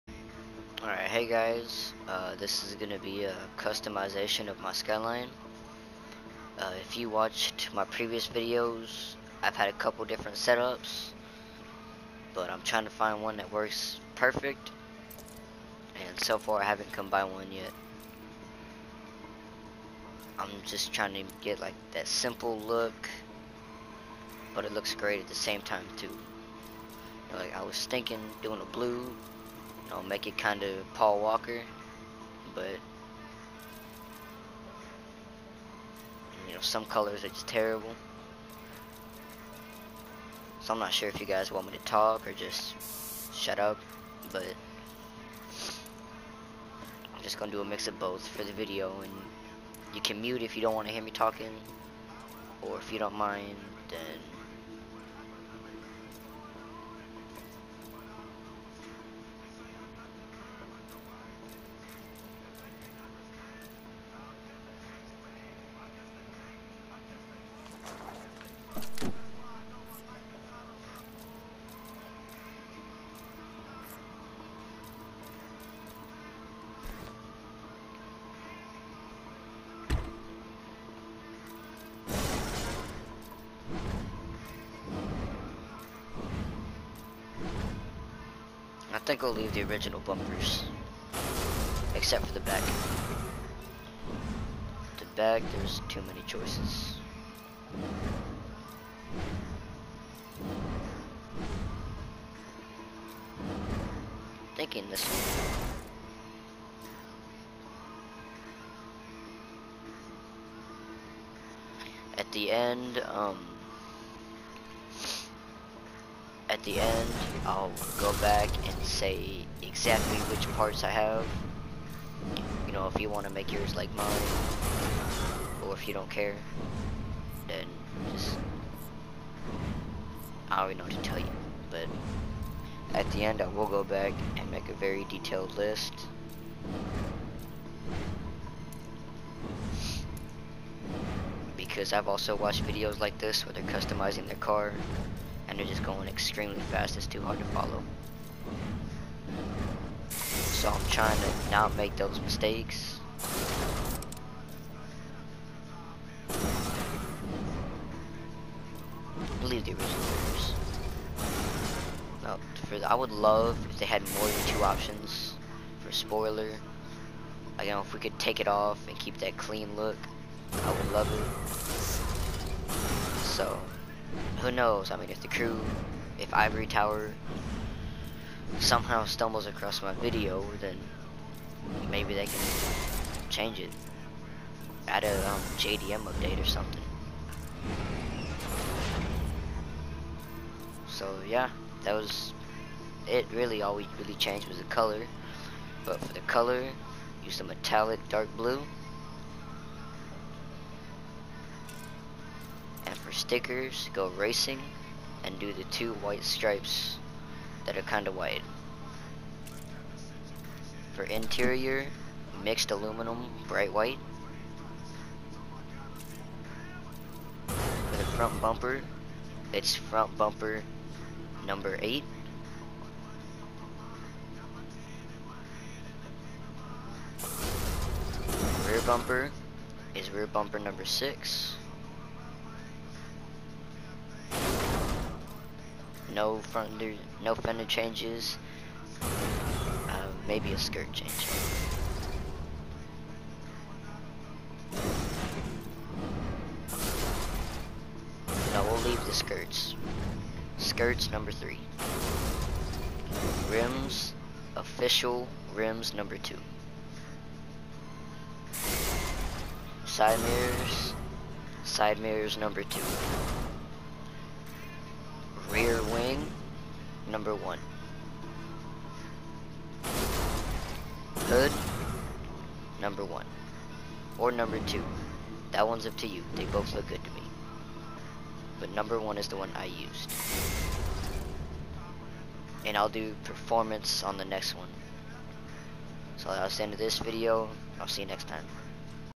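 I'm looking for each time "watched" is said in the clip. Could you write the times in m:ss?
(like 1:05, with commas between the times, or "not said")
0:07, 2:22.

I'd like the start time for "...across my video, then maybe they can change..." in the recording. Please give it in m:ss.
2:59.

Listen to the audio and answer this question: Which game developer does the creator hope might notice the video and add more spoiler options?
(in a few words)
Ivory Tower.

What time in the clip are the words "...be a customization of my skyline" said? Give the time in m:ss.
0:02.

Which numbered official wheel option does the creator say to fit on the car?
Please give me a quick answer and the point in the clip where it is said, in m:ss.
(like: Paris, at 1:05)
2, at 4:14.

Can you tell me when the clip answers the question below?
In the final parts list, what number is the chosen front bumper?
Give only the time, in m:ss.
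3:41.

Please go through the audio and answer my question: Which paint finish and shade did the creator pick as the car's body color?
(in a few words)
metallic dark blue.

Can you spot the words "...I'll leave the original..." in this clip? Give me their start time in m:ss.
1:29.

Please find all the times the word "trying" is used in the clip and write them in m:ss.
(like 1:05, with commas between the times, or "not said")
0:12, 0:20, 2:30.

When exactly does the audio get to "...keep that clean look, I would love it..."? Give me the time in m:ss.
2:48.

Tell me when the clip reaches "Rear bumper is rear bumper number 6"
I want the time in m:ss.
3:48.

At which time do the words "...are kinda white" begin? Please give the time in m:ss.
3:27.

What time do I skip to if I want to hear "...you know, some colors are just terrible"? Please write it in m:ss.
0:36.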